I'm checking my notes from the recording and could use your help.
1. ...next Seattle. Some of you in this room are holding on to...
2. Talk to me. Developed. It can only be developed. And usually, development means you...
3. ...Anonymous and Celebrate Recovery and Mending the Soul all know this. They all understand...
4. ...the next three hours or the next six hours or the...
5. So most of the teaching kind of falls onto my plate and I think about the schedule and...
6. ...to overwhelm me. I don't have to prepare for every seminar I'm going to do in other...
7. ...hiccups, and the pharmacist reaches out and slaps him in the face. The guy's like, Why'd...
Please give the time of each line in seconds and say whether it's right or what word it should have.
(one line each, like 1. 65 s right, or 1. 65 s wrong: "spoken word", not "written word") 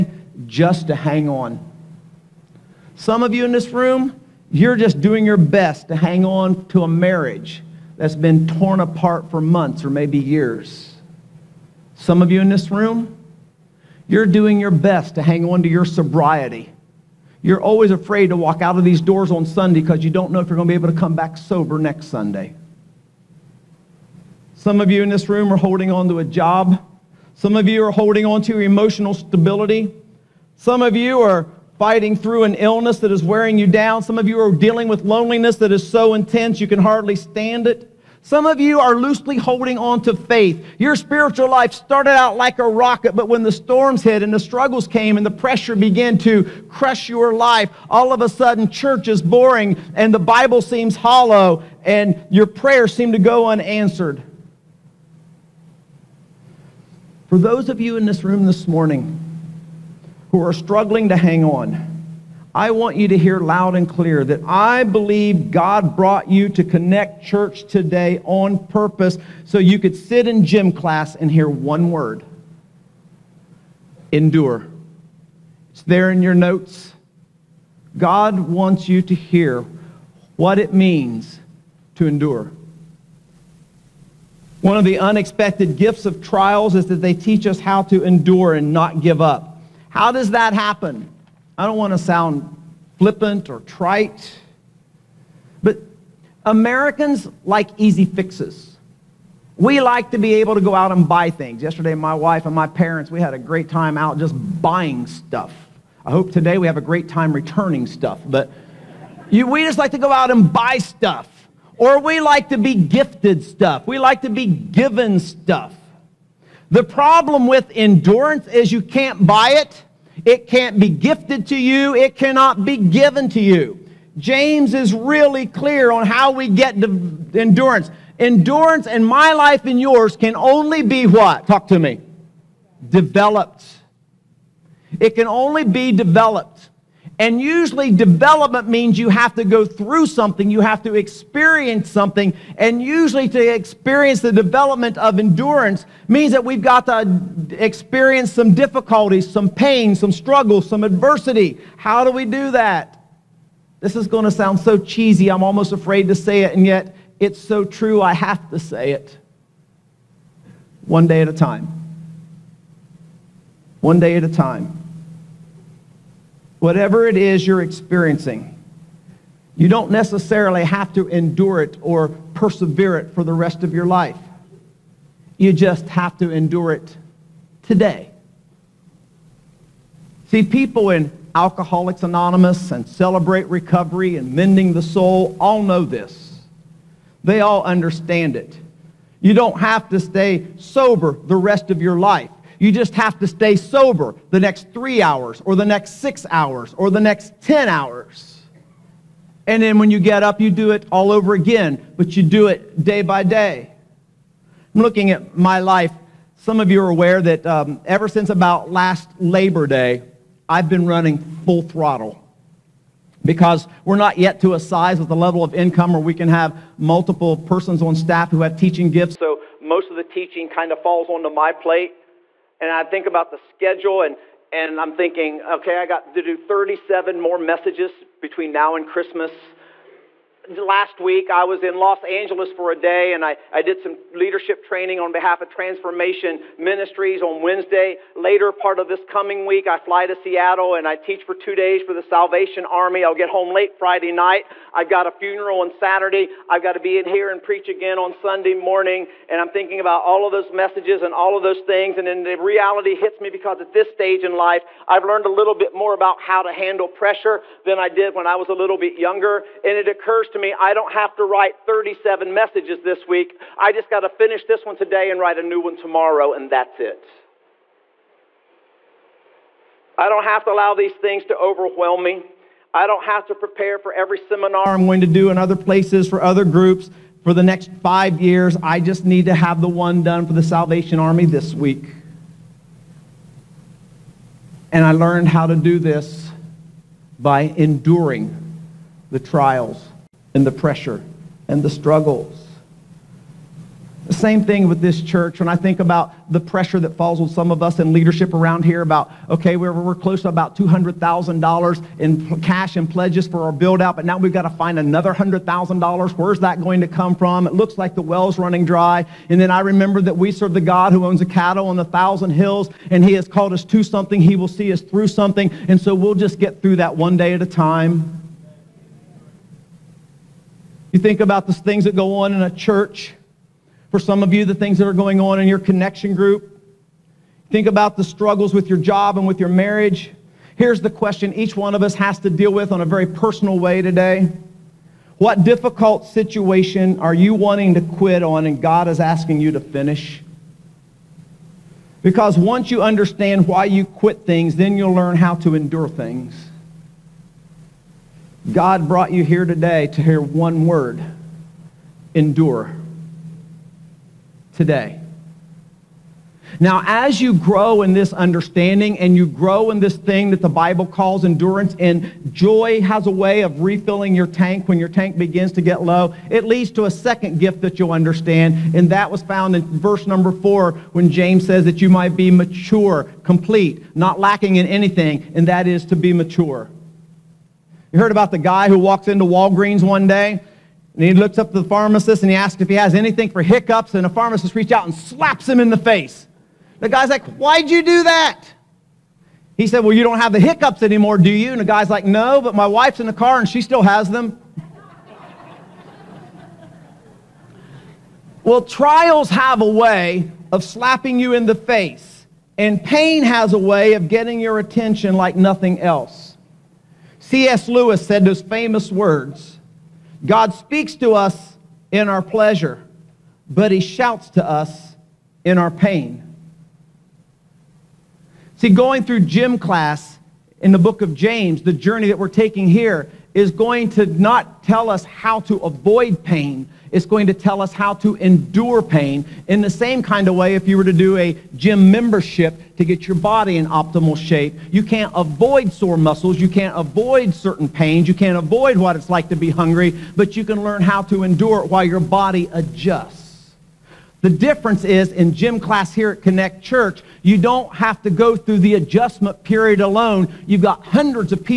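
1. 21 s wrong: "Sunday", not "Seattle"
2. 131 s right
3. 182 s right
4. 194 s right
5. 219 s right
6. 271 s right
7. 383 s right.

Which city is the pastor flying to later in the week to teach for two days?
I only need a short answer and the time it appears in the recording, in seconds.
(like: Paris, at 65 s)
Seattle, at 240 s.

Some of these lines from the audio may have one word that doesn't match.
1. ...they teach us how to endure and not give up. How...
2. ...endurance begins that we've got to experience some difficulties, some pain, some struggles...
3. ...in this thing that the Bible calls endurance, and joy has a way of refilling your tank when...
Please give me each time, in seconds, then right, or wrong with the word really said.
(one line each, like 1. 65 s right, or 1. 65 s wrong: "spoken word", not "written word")
1. 86 s right
2. 145 s wrong: "means", not "begins"
3. 359 s right.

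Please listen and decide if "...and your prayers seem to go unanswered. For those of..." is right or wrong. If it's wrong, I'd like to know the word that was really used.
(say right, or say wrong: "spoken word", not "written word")
right.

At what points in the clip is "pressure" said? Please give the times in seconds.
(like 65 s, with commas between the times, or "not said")
45 s, 256 s, 290 s, 296 s.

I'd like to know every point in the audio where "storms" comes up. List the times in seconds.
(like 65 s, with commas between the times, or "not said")
43 s.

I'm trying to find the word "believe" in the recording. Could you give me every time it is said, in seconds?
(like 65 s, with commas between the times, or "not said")
64 s.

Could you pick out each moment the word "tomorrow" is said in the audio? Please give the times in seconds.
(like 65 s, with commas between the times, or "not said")
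265 s.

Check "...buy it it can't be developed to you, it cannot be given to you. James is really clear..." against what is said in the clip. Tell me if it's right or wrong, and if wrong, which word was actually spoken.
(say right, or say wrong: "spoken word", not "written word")
wrong: "gifted", not "developed".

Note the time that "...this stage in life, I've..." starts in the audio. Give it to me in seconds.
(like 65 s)
253 s.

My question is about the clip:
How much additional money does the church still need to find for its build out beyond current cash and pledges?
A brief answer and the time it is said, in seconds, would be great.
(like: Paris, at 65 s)
$100,000, at 305 s.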